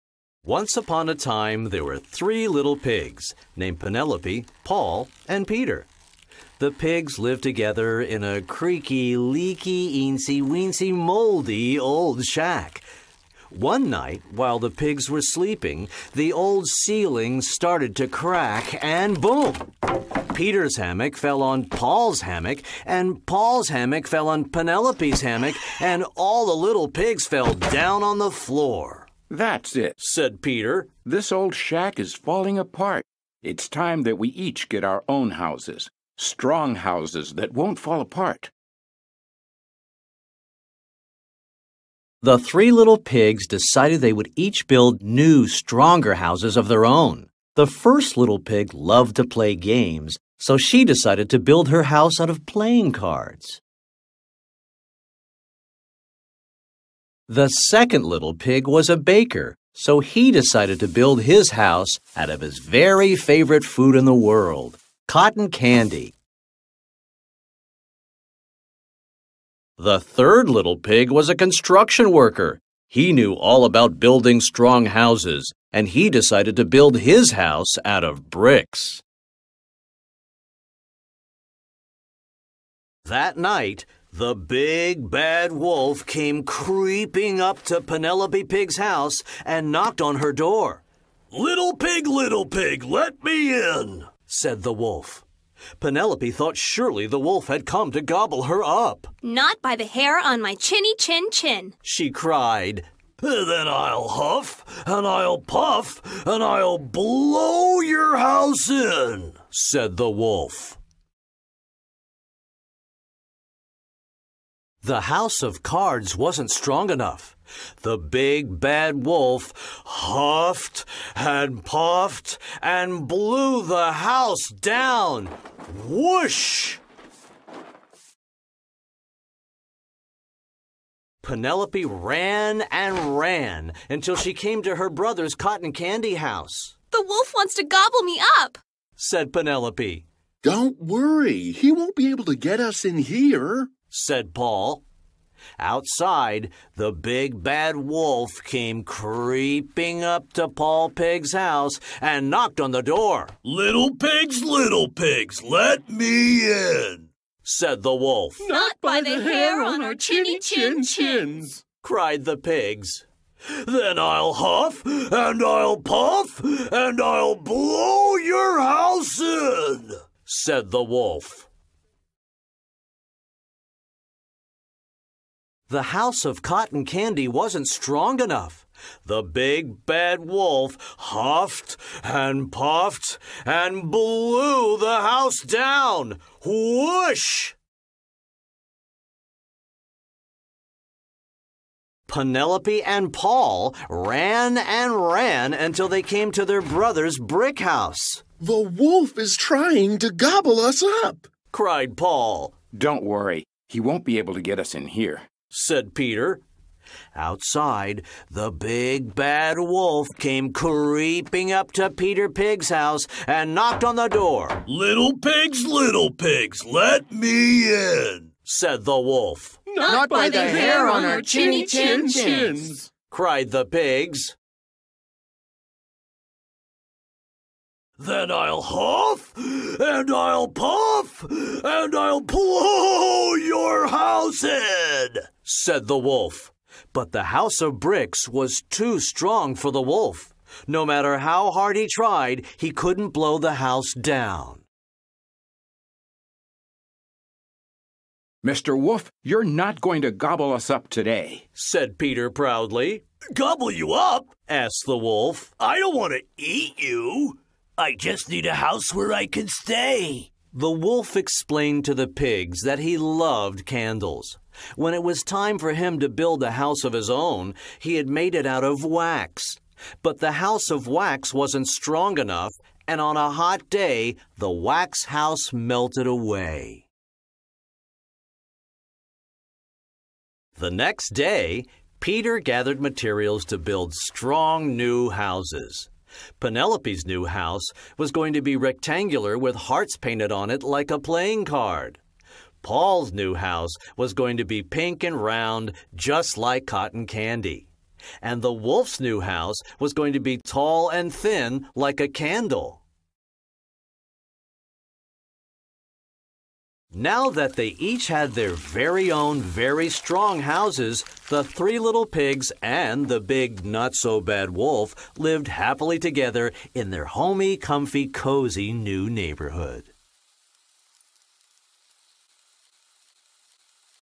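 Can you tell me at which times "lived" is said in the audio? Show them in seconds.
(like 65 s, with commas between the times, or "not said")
7 s, 315 s.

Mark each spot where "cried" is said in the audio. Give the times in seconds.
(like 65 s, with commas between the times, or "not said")
102 s, 161 s, 201 s, 223 s.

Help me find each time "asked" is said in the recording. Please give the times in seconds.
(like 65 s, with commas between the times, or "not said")
254 s.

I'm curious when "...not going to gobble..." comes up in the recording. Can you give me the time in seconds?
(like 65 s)
249 s.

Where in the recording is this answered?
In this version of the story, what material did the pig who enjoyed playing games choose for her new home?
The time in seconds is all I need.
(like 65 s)
52 s.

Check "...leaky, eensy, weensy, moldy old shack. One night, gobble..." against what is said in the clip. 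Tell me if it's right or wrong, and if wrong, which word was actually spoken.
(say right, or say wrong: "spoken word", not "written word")
wrong: "while", not "gobble".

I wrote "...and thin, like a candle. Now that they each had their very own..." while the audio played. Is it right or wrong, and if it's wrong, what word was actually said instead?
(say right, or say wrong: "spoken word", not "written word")
right.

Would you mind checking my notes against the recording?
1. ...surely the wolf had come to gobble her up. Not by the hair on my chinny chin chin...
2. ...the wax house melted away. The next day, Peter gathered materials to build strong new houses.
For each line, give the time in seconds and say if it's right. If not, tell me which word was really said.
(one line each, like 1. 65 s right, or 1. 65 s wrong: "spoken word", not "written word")
1. 96 s right
2. 274 s right.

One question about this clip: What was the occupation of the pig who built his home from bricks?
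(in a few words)
Construction worker.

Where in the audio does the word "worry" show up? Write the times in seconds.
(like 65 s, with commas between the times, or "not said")
140 s, 203 s.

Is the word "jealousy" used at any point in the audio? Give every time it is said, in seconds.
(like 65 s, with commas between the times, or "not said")
not said.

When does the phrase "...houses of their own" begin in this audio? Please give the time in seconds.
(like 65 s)
46 s.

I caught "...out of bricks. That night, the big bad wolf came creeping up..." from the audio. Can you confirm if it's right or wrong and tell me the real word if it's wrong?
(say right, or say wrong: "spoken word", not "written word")
right.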